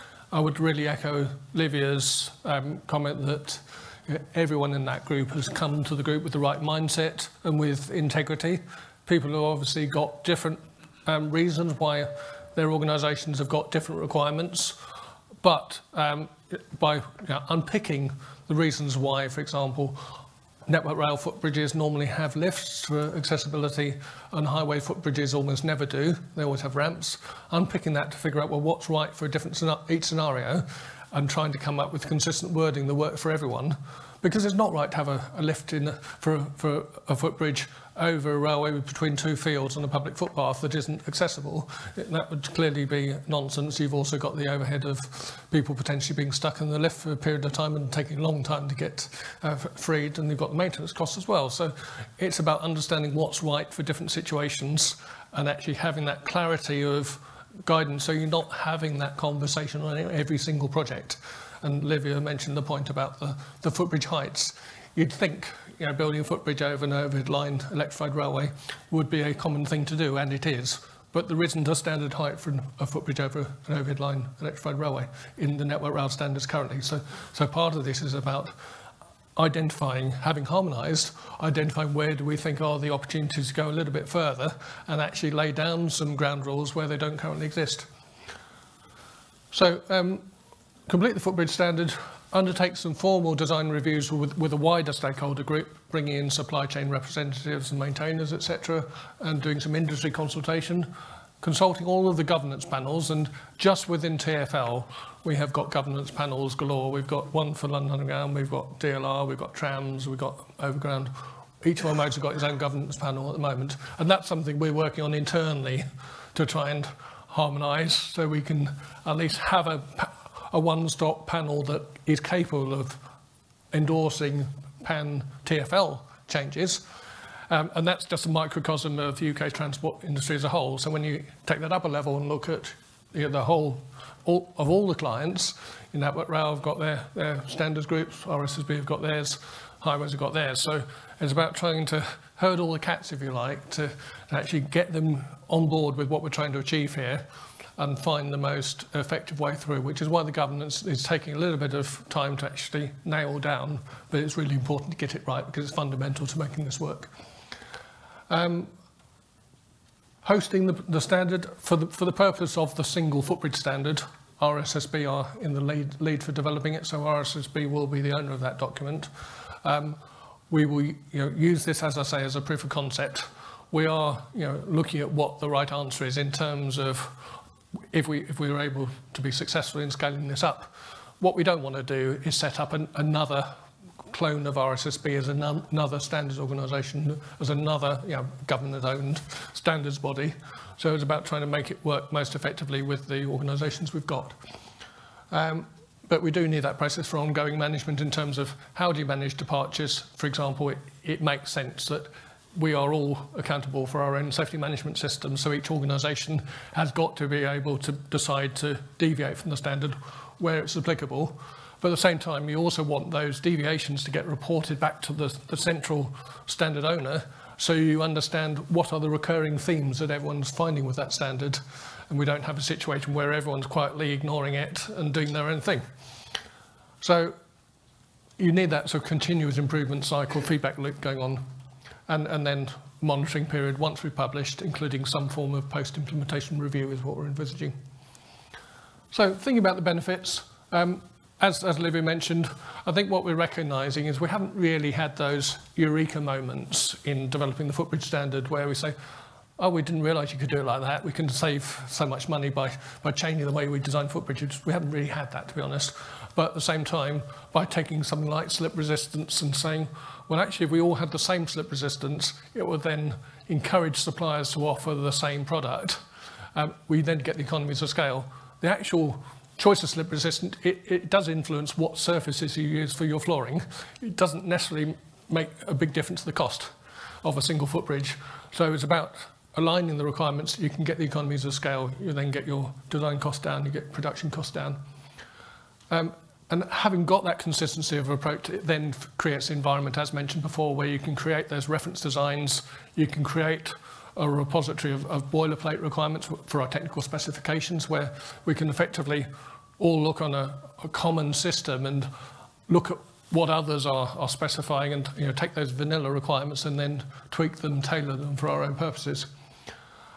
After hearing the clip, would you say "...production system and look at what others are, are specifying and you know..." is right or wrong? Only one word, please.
wrong.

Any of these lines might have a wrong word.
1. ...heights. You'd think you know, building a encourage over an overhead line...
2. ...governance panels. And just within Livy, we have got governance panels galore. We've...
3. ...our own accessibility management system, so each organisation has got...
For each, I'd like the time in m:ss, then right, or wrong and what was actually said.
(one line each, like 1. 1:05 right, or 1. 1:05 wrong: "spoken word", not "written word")
1. 1:04 wrong: "footbridge", not "encourage"
2. 1:42 wrong: "TfL", not "Livy"
3. 3:24 wrong: "safety", not "accessibility".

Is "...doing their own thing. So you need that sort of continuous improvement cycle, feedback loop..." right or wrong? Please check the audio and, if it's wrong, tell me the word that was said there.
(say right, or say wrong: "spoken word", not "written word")
right.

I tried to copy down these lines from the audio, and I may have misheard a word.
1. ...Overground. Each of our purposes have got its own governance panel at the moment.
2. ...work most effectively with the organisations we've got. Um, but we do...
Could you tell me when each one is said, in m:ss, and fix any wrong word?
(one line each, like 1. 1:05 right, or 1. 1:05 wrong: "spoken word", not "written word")
1. 1:50 wrong: "modes", not "purposes"
2. 3:11 right.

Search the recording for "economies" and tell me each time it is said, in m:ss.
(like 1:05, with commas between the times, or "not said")
4:27, 4:41.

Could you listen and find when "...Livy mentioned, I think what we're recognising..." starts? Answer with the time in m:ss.
4:01.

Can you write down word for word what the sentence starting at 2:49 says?
Um, we will you know, use this, as I say, as a proof of concept.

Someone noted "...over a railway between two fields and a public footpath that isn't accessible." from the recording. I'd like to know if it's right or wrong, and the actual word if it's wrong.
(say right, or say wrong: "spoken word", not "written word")
right.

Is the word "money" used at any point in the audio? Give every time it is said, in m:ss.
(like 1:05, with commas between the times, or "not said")
4:12.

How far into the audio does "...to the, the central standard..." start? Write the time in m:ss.
3:35.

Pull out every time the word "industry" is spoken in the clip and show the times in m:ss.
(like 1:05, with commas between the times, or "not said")
1:39, 2:10.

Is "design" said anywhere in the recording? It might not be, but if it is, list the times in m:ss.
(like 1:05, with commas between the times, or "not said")
1:33, 4:13, 4:42, 4:51.